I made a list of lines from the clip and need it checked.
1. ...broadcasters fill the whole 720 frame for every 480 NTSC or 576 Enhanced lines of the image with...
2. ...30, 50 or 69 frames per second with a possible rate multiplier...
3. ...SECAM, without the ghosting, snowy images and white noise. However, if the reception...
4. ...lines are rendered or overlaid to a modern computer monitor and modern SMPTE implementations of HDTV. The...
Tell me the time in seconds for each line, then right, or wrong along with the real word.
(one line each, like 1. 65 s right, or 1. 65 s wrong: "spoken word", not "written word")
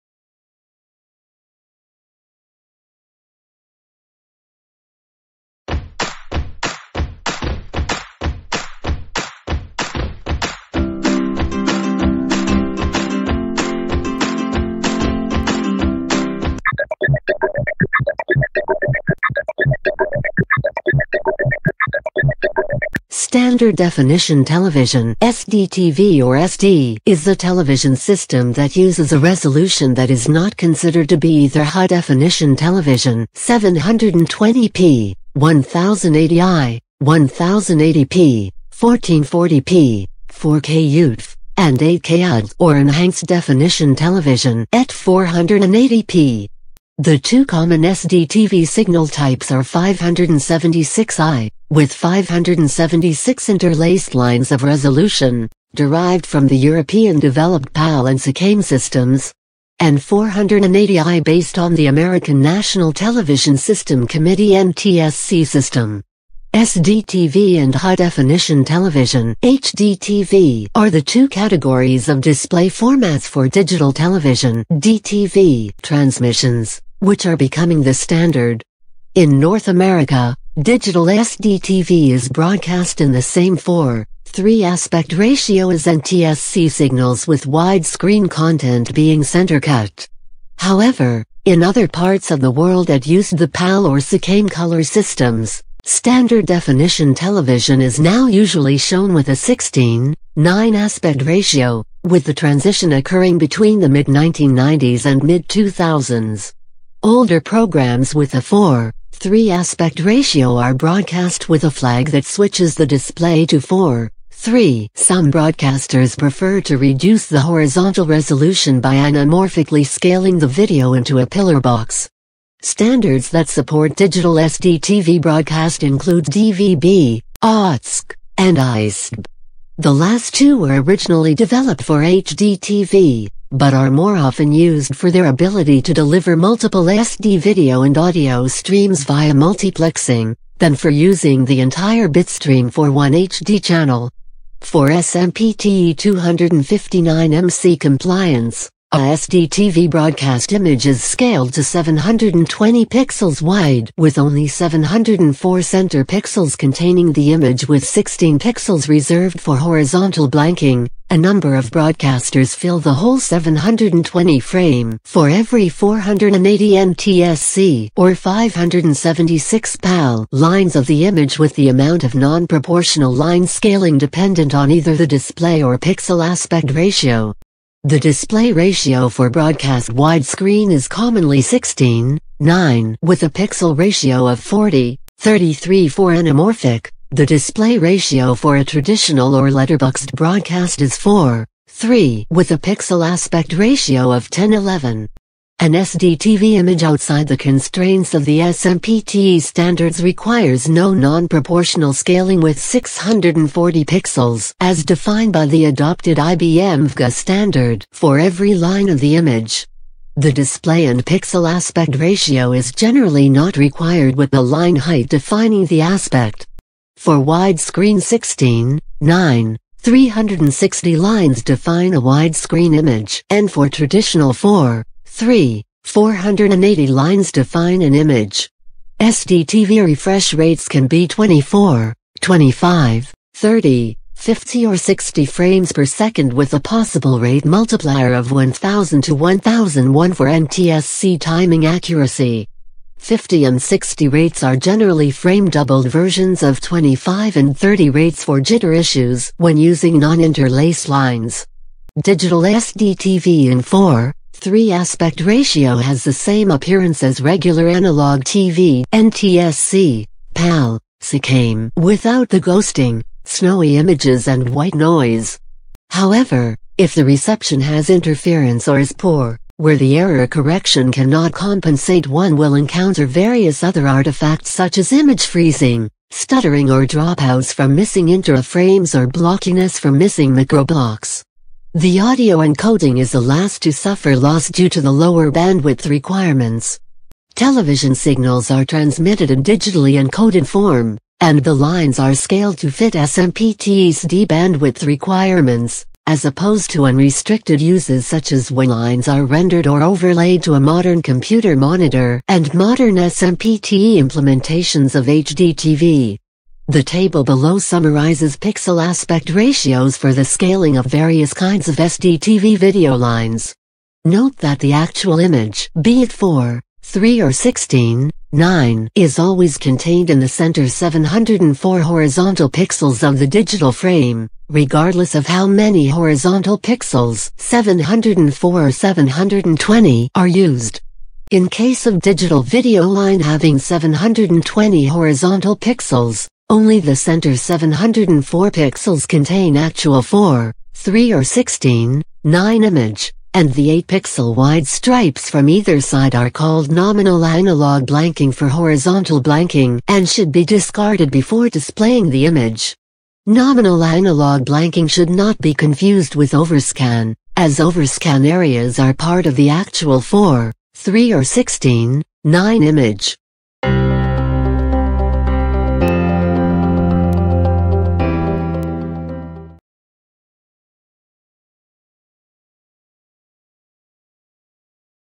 1. 161 s wrong: "PAL", not "Enhanced"
2. 233 s wrong: "60", not "69"
3. 260 s right
4. 298 s right.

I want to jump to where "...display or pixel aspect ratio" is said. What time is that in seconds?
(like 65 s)
175 s.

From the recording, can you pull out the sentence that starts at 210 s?
The display and pixel aspect ratio is generally not required with the line height defining the aspect.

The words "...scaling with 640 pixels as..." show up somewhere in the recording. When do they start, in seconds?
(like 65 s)
201 s.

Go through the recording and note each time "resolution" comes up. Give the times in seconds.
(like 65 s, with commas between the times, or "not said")
29 s, 54 s, 118 s.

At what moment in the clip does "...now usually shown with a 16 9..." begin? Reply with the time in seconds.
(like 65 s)
97 s.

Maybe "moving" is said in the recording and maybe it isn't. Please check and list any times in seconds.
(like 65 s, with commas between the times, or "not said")
not said.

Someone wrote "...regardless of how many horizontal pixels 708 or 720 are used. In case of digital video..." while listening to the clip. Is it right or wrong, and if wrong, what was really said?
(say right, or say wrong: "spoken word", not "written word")
wrong: "704", not "708".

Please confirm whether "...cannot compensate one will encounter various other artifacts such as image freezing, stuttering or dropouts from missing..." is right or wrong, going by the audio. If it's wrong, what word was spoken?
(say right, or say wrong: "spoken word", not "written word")
right.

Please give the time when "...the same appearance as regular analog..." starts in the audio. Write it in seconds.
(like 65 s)
256 s.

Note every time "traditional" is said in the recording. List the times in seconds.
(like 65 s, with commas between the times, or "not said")
188 s, 223 s.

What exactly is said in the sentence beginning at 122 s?
Standards that support digital SD TV broadcast include DVB, ATSC, and ISDB.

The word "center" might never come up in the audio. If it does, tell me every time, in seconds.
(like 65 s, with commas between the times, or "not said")
89 s, 155 s, 320 s, 336 s.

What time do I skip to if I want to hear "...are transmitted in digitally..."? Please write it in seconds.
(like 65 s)
288 s.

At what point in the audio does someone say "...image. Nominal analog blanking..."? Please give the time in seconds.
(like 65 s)
352 s.